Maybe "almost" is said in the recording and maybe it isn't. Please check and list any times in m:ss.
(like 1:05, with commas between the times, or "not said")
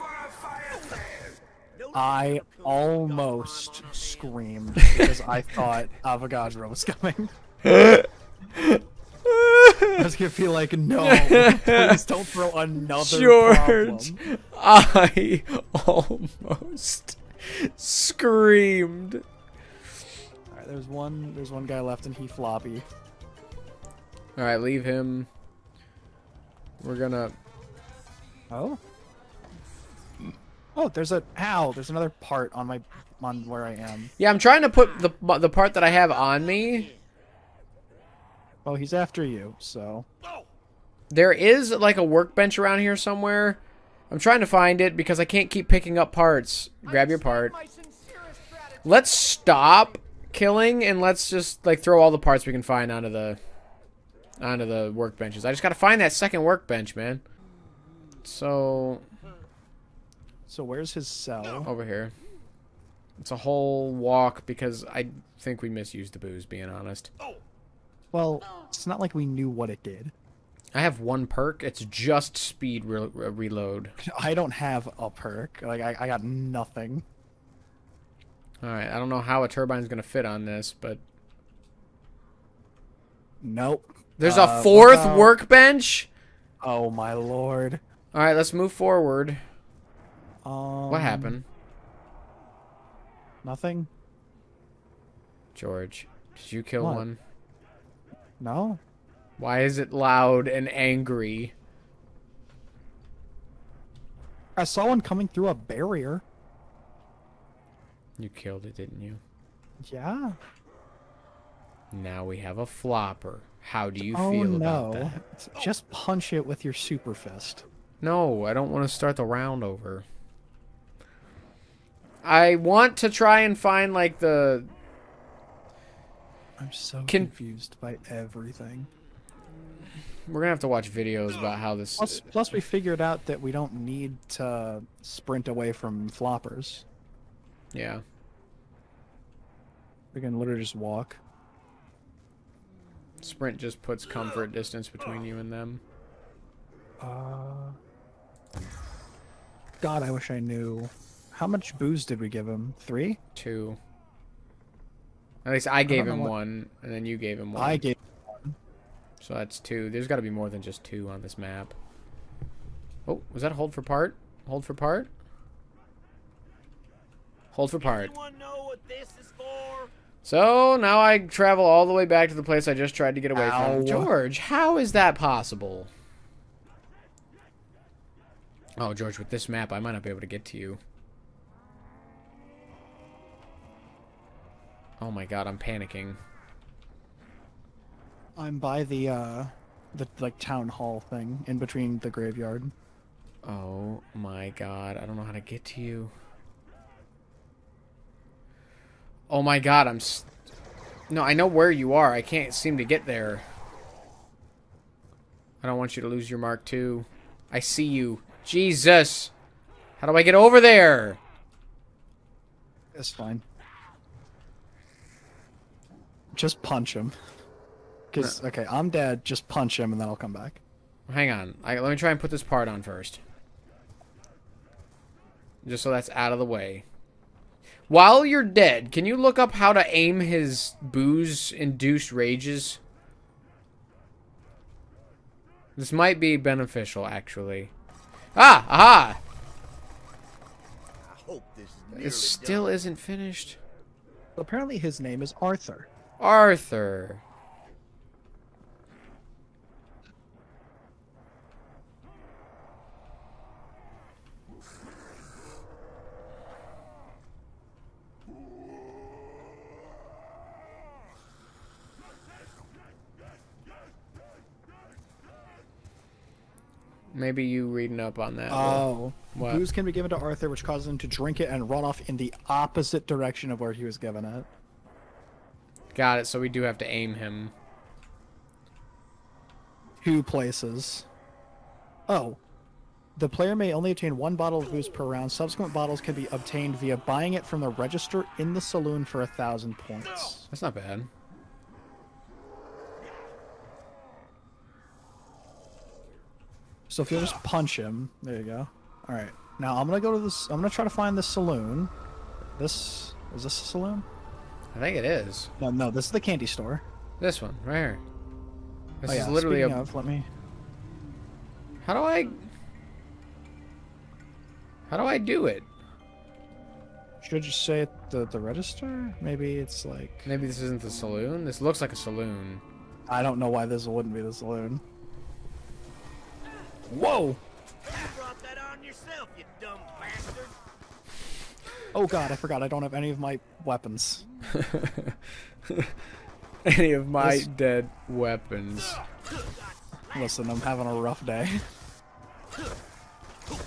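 0:02, 0:15.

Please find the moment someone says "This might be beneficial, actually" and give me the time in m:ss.
3:55.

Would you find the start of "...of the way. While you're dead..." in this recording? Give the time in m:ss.
3:46.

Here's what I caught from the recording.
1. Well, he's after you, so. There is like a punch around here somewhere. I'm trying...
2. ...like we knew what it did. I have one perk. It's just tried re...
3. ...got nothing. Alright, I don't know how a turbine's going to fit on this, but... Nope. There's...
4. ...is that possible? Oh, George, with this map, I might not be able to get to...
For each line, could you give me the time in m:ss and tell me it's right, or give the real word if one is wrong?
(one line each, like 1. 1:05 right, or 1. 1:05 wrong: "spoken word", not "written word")
1. 0:38 wrong: "workbench", not "punch"
2. 1:08 wrong: "speed", not "tried"
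3. 1:16 right
4. 2:54 right.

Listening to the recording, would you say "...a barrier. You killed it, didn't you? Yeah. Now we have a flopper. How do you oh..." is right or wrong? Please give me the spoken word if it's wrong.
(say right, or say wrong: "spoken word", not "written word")
right.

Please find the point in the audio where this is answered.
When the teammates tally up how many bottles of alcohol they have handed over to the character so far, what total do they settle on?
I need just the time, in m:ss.
2:39.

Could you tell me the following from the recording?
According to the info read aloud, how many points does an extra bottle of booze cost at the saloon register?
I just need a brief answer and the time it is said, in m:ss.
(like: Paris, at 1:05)
1000, at 4:49.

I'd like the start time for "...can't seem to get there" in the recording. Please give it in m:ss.
3:22.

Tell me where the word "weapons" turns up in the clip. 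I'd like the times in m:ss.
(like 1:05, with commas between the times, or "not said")
5:33, 5:38.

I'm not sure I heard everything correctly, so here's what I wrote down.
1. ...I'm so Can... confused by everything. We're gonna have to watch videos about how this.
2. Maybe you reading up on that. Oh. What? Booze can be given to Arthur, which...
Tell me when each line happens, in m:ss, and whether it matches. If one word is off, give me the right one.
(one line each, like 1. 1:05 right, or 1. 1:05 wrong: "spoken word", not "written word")
1. 2:06 right
2. 4:27 right.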